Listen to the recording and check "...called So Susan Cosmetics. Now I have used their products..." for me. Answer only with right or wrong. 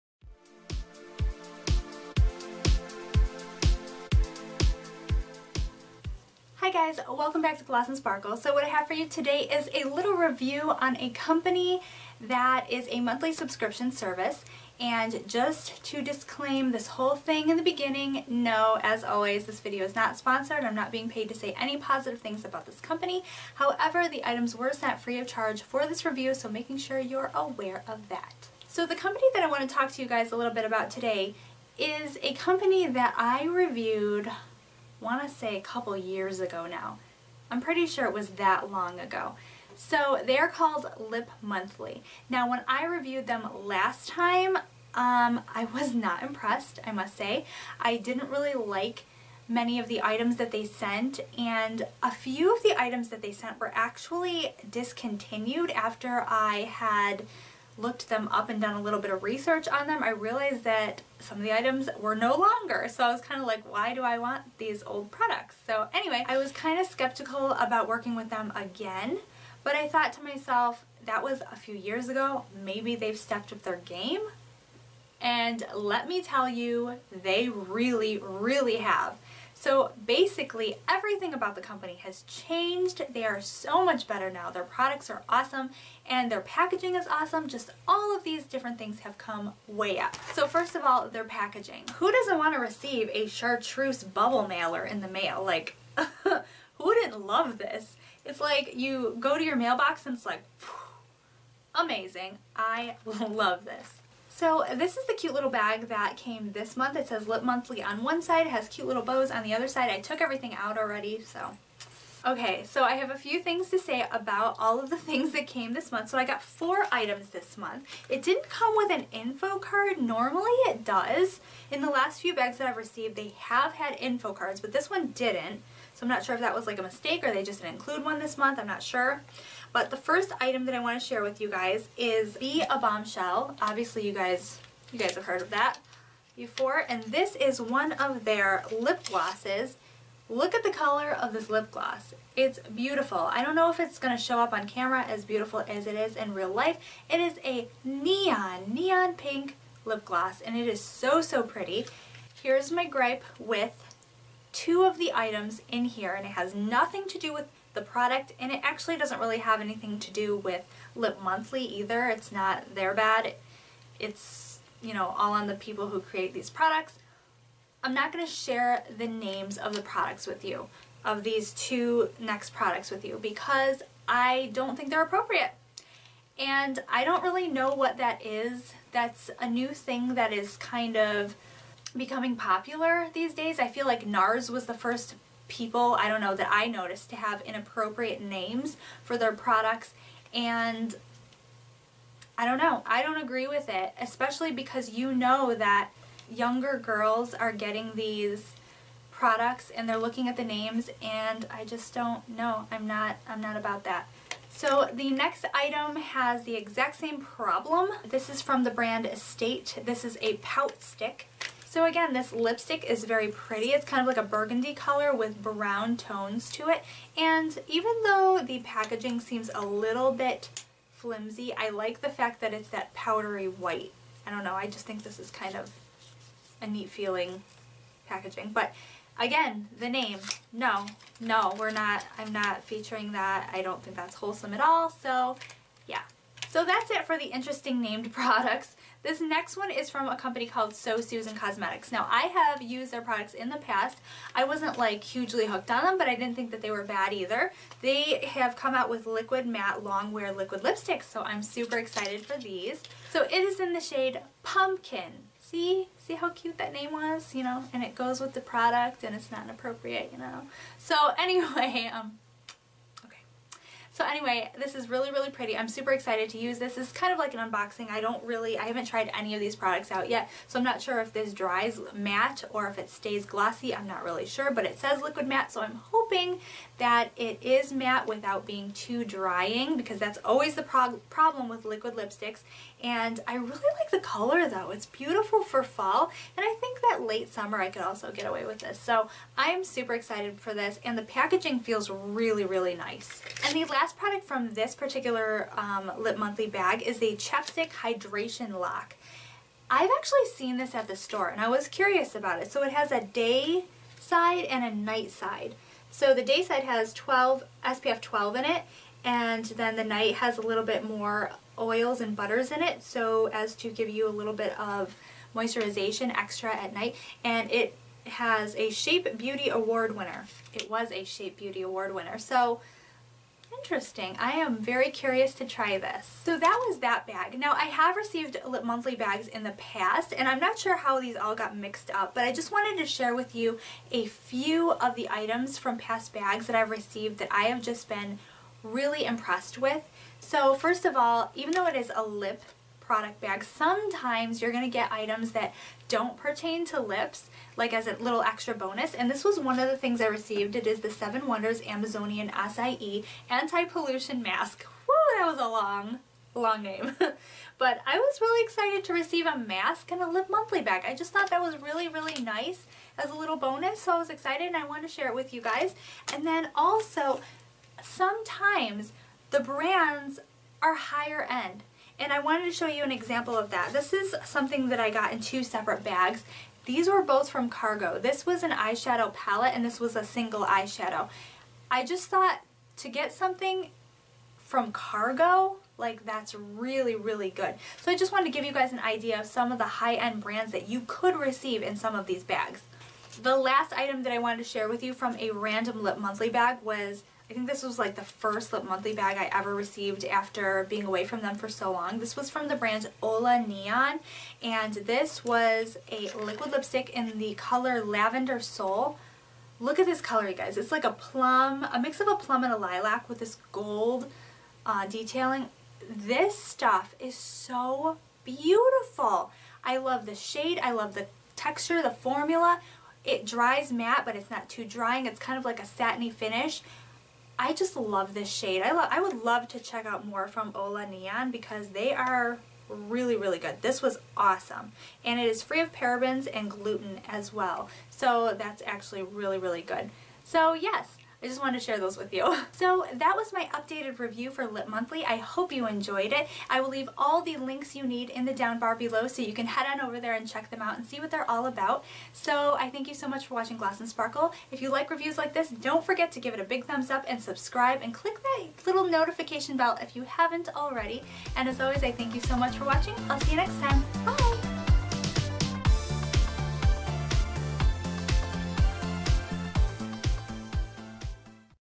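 right.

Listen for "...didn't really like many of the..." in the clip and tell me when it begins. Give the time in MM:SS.
00:47.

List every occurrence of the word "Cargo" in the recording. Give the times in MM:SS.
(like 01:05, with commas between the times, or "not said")
06:17, 06:24.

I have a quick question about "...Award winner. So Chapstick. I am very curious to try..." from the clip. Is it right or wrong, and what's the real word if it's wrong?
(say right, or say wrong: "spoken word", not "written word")
wrong: "Interesting", not "Chapstick".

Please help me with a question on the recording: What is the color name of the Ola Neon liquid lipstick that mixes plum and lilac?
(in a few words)
Lavender Soul.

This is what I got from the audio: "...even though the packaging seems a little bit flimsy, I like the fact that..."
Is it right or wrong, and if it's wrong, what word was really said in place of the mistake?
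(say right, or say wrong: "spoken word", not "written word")
right.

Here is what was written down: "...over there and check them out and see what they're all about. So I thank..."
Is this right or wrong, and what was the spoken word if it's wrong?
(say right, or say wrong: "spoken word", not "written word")
right.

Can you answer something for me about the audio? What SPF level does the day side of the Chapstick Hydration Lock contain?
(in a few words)
12.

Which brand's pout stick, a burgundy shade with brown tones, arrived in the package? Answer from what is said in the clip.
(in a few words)
Estate.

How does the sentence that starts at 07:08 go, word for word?
I, I would love to check out more from Ola Neon because they are really, really good.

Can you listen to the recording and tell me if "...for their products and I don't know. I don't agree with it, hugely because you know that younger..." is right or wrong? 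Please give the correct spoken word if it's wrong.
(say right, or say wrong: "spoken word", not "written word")
wrong: "especially", not "hugely".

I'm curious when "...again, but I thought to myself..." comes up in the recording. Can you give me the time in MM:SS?
01:08.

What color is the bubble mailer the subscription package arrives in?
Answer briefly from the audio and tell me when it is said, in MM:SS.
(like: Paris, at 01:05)
Chartreuse, at 01:33.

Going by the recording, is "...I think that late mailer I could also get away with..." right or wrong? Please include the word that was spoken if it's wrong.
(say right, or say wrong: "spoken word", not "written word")
wrong: "summer", not "mailer".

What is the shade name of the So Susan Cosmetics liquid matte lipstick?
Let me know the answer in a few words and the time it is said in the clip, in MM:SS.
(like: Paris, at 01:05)
Pumpkin, at 04:14.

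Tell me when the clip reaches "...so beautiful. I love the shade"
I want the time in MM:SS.
06:57.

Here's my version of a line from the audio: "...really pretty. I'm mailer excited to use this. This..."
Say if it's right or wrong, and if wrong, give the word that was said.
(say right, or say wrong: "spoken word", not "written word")
wrong: "super", not "mailer".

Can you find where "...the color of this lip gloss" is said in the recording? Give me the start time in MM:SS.
02:20.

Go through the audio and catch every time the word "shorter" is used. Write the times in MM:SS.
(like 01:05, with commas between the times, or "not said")
not said.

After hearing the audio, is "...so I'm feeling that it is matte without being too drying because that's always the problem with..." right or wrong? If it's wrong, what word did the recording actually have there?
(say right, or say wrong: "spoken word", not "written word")
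wrong: "hoping", not "feeling".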